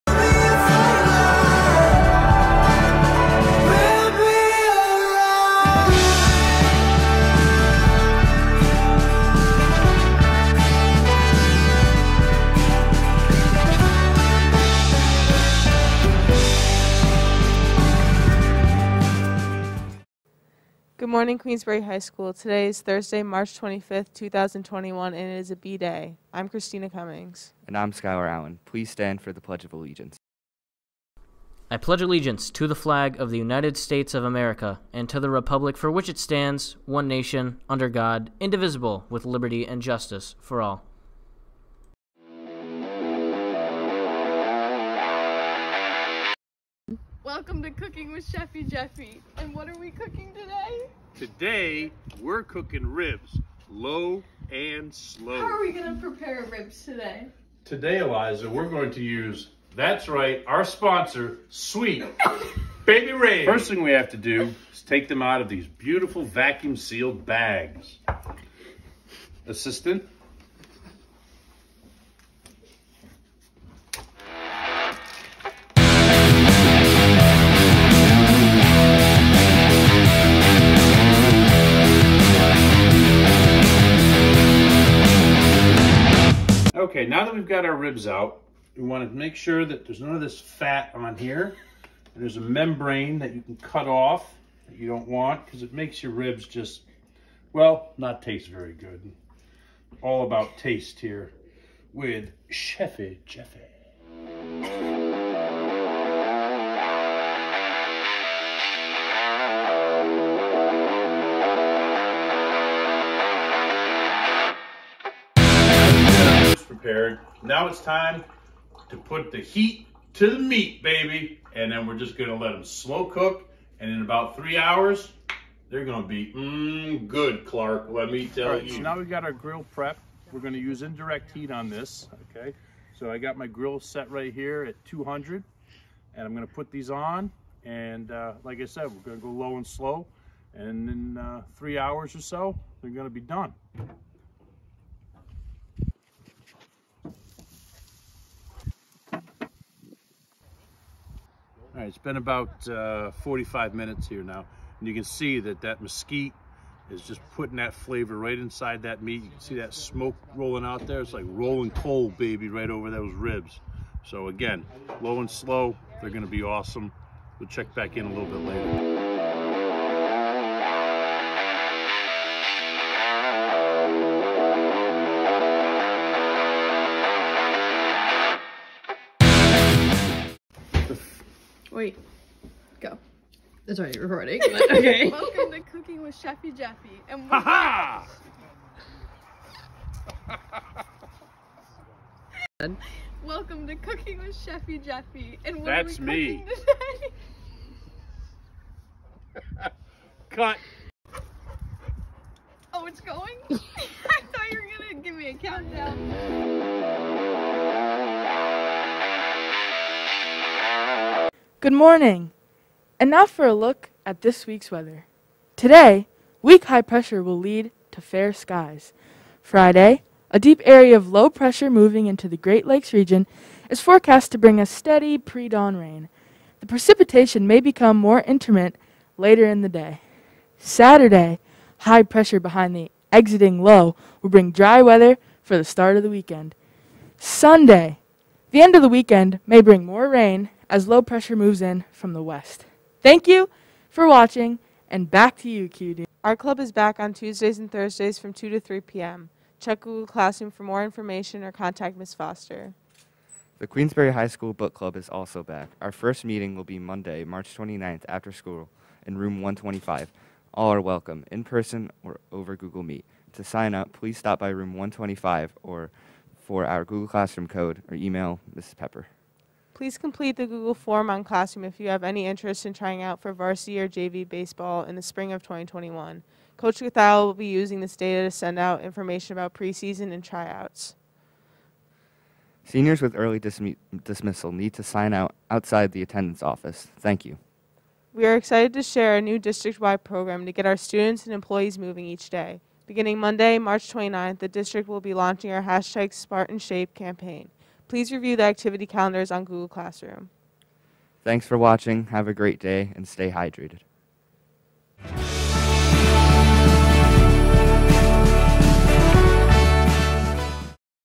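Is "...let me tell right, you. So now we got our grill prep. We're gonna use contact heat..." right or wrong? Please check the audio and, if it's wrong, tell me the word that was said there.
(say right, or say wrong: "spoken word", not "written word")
wrong: "indirect", not "contact".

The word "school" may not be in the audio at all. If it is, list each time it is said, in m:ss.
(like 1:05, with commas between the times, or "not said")
0:21, 4:14, 4:18.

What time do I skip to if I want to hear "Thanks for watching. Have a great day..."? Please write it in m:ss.
5:01.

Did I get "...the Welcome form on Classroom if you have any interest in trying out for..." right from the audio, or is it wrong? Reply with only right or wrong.
wrong.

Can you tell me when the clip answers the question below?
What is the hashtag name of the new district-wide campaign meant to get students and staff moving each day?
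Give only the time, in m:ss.
4:56.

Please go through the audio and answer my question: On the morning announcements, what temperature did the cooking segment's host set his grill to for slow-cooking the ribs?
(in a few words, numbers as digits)
200.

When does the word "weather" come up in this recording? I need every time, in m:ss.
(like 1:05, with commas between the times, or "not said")
3:34, 3:54.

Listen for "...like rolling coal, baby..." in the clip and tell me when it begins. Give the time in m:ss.
2:41.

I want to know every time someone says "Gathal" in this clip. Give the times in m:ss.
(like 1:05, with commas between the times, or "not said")
4:36.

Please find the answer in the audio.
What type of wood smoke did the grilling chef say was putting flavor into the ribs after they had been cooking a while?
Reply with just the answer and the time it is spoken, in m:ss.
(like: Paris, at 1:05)
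mesquite, at 2:35.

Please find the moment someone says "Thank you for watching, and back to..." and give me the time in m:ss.
4:03.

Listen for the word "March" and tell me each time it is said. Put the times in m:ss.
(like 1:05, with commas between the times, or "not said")
0:23, 4:17, 4:53.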